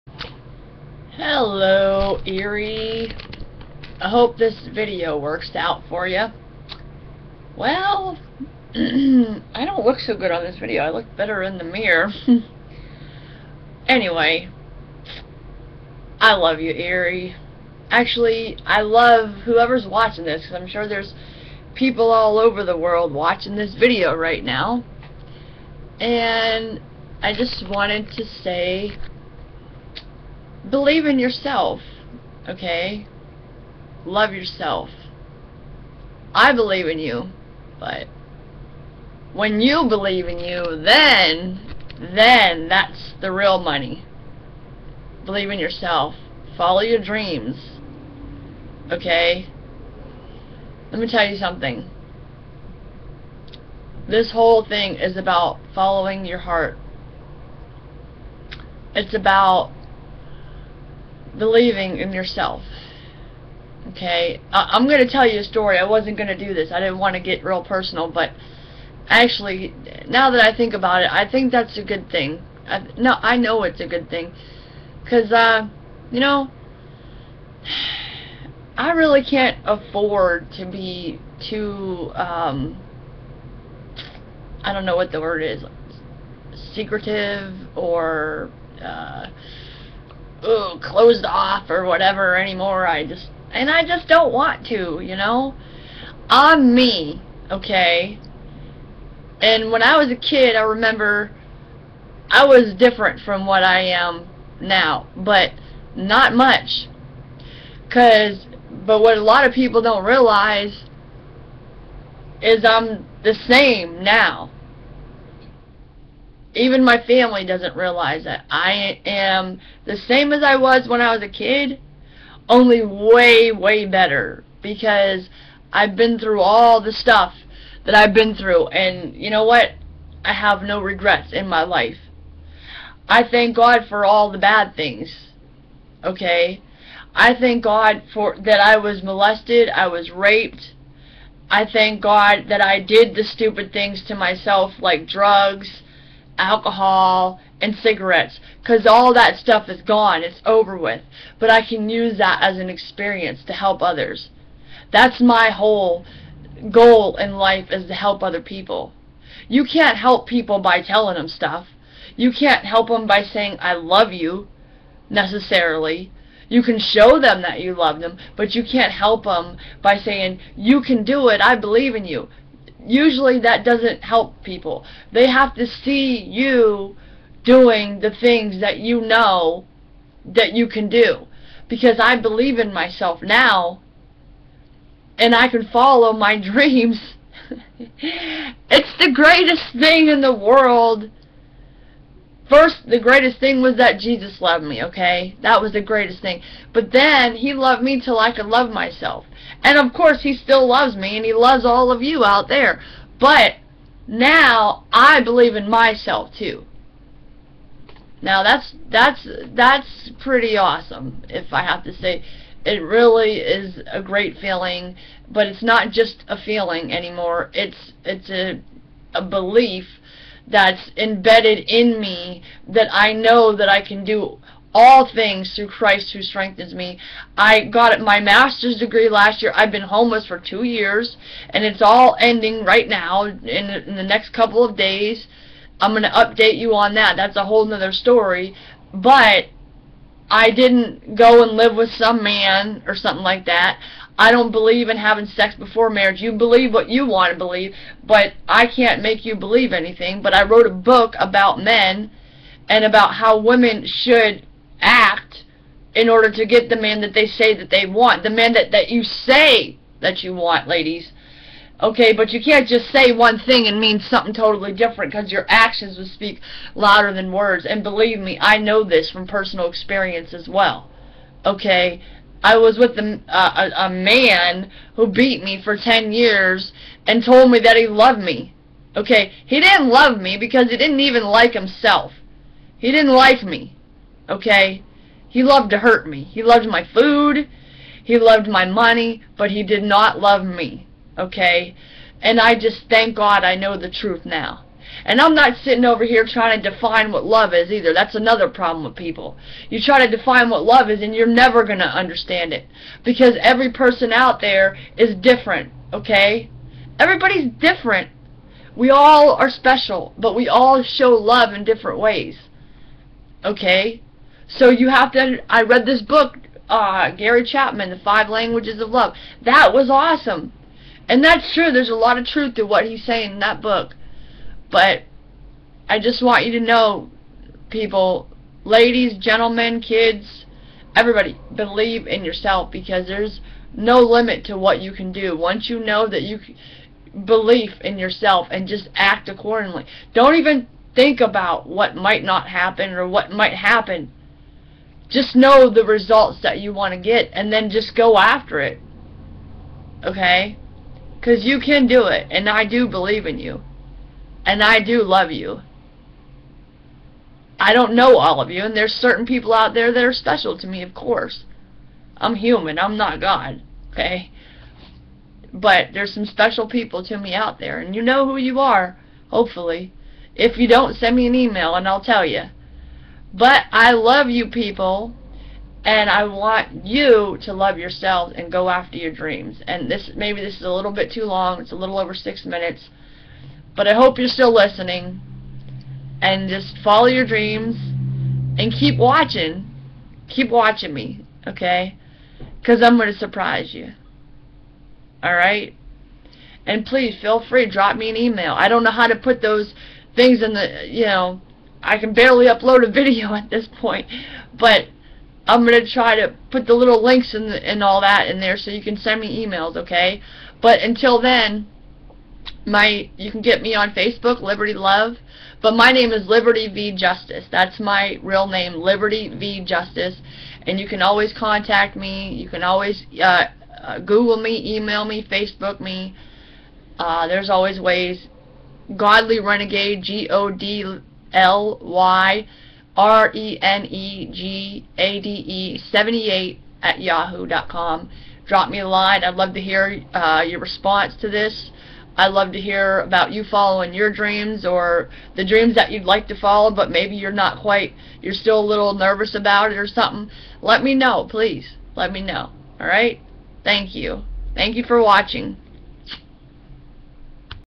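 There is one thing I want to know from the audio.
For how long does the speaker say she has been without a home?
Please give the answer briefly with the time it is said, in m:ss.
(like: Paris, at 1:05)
2 years, at 3:50.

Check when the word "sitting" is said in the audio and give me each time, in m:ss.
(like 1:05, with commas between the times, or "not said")
4:55.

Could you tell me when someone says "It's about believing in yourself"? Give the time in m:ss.
0:58.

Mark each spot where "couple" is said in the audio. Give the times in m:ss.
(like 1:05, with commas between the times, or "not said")
3:54.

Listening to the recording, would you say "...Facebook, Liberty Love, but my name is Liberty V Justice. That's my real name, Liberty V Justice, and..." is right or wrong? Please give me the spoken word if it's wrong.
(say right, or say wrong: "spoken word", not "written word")
right.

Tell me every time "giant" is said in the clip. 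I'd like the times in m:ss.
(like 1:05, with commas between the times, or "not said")
not said.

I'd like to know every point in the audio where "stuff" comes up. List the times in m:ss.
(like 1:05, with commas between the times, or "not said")
2:06, 2:29, 2:41.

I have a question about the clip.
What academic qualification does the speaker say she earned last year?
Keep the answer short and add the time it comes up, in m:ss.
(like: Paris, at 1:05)
Master's degree, at 3:48.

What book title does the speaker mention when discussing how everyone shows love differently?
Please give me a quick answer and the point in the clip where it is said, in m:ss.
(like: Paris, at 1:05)
The Five Languages of Love, at 5:17.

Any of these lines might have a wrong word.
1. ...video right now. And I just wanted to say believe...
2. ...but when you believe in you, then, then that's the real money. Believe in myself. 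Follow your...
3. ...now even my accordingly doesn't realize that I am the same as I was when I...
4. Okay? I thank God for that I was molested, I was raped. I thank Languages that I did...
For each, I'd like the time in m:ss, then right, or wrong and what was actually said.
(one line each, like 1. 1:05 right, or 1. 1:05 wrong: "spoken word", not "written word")
1. 0:23 right
2. 0:37 wrong: "yourself", not "myself"
3. 1:54 wrong: "family", not "accordingly"
4. 2:16 wrong: "God", not "Languages".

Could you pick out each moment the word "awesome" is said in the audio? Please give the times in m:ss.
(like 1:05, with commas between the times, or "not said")
3:30, 5:19.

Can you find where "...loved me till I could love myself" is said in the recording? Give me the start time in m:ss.
3:17.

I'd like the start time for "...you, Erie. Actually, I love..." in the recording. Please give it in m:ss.
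0:16.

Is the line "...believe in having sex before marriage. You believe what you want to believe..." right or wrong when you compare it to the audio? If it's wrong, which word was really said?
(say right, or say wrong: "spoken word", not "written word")
right.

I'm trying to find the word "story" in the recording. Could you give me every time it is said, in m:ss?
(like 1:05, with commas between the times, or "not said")
1:05, 3:57.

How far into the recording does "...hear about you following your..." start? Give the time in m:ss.
7:22.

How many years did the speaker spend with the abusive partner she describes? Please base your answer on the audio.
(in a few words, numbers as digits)
10 years.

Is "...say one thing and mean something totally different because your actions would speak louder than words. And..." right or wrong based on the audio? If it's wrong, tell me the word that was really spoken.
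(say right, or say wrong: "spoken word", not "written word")
right.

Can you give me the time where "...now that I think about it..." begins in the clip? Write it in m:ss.
1:10.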